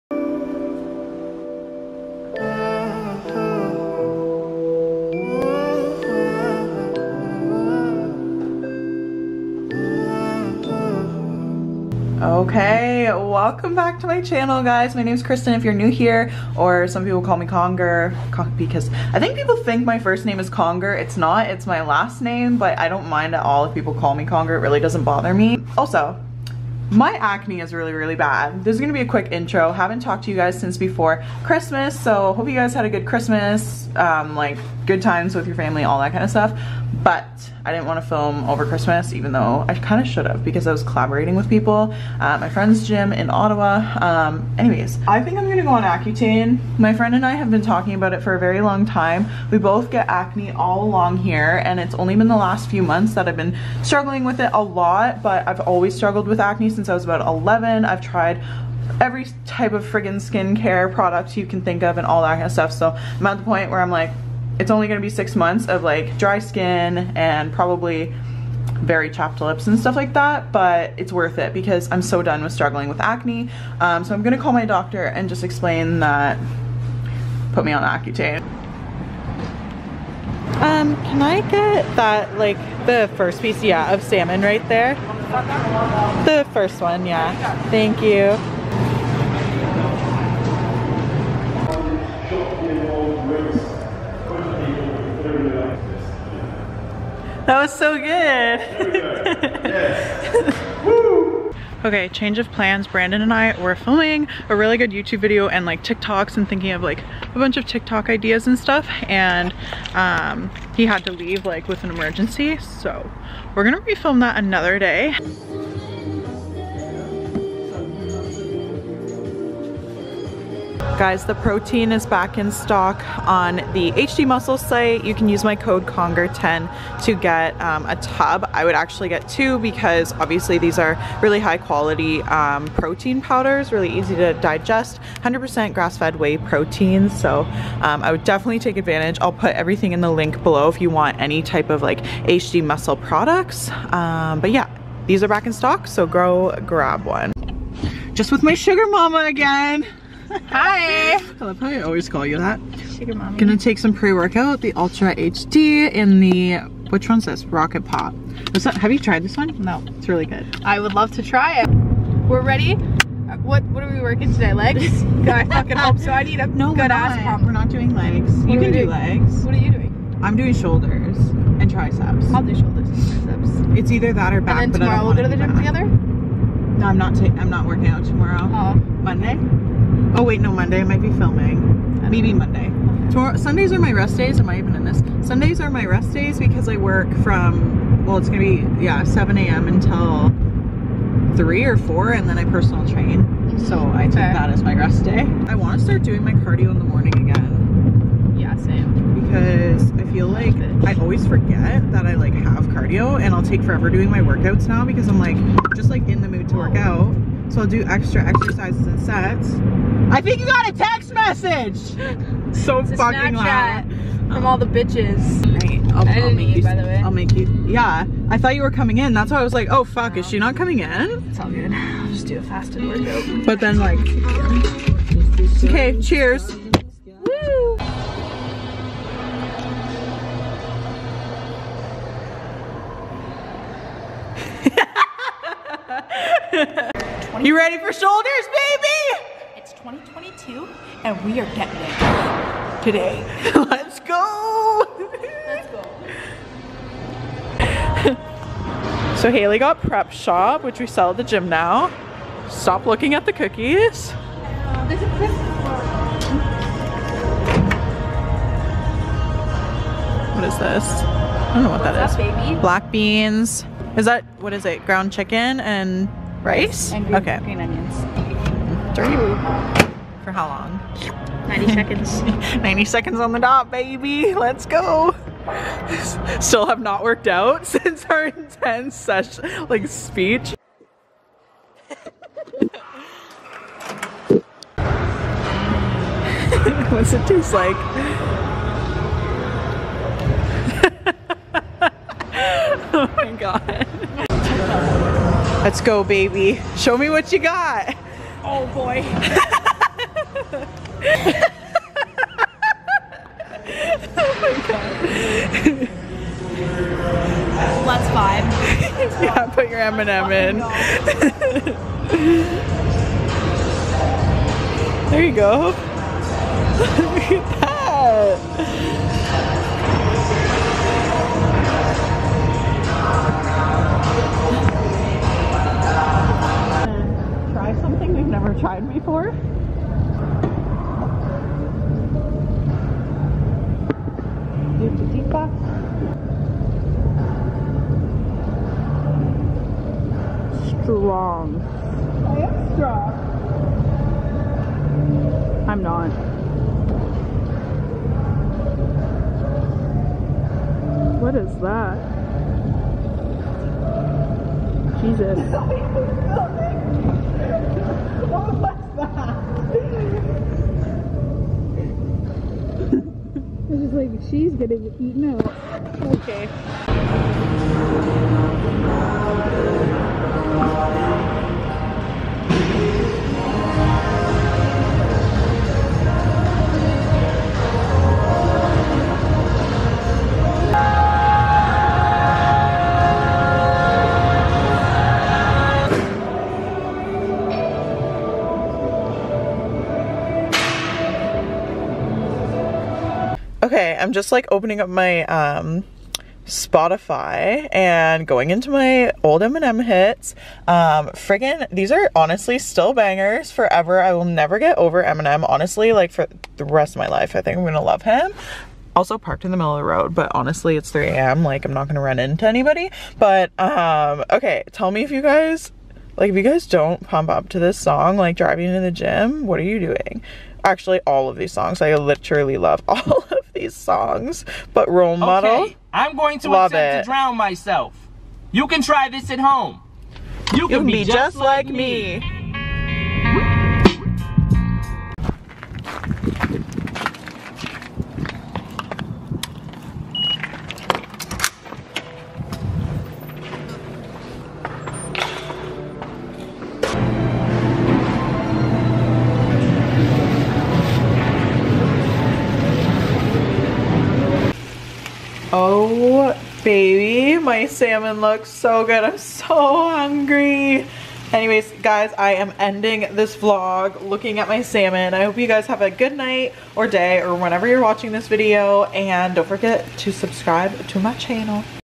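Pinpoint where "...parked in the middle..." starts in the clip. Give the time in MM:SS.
06:49.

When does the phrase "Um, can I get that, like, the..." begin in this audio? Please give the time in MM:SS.
01:20.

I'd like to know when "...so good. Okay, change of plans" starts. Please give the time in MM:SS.
01:37.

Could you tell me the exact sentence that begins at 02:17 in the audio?
So um, I would definitely take advantage.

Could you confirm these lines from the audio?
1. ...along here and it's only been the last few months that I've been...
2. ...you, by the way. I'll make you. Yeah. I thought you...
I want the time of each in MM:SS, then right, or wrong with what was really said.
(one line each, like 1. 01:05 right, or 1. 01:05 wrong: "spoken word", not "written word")
1. 00:50 right
2. 03:36 right.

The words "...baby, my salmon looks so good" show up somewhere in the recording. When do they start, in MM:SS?
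07:36.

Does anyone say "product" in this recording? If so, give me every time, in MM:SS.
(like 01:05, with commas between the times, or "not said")
01:00, 02:22.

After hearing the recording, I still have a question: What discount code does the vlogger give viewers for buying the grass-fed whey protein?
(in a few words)
CONGER10.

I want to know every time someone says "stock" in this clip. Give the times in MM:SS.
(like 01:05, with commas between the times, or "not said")
02:02, 02:25.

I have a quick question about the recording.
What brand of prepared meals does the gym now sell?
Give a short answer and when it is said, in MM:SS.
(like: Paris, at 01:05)
prep shop, at 04:09.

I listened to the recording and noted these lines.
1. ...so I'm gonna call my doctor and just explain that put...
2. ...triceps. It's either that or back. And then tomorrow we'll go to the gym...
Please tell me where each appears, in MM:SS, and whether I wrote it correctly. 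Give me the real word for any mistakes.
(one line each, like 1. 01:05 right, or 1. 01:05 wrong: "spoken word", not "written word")
1. 01:14 right
2. 02:53 right.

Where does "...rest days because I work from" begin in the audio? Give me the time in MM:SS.
03:05.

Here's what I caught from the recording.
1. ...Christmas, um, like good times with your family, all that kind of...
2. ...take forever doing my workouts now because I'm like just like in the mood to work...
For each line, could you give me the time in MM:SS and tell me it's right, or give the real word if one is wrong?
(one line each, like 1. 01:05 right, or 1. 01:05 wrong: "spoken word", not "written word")
1. 00:33 right
2. 03:23 right.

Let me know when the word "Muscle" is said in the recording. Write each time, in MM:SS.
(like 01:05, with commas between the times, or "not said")
02:04, 02:22.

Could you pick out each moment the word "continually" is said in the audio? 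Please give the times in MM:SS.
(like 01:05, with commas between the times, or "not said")
not said.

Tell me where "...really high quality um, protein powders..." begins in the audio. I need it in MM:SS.
02:11.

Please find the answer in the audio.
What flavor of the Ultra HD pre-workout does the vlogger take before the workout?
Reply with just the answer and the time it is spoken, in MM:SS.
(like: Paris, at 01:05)
Rocket Pop, at 02:37.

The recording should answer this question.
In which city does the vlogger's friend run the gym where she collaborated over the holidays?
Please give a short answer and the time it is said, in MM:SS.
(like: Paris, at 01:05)
Ottawa, at 00:43.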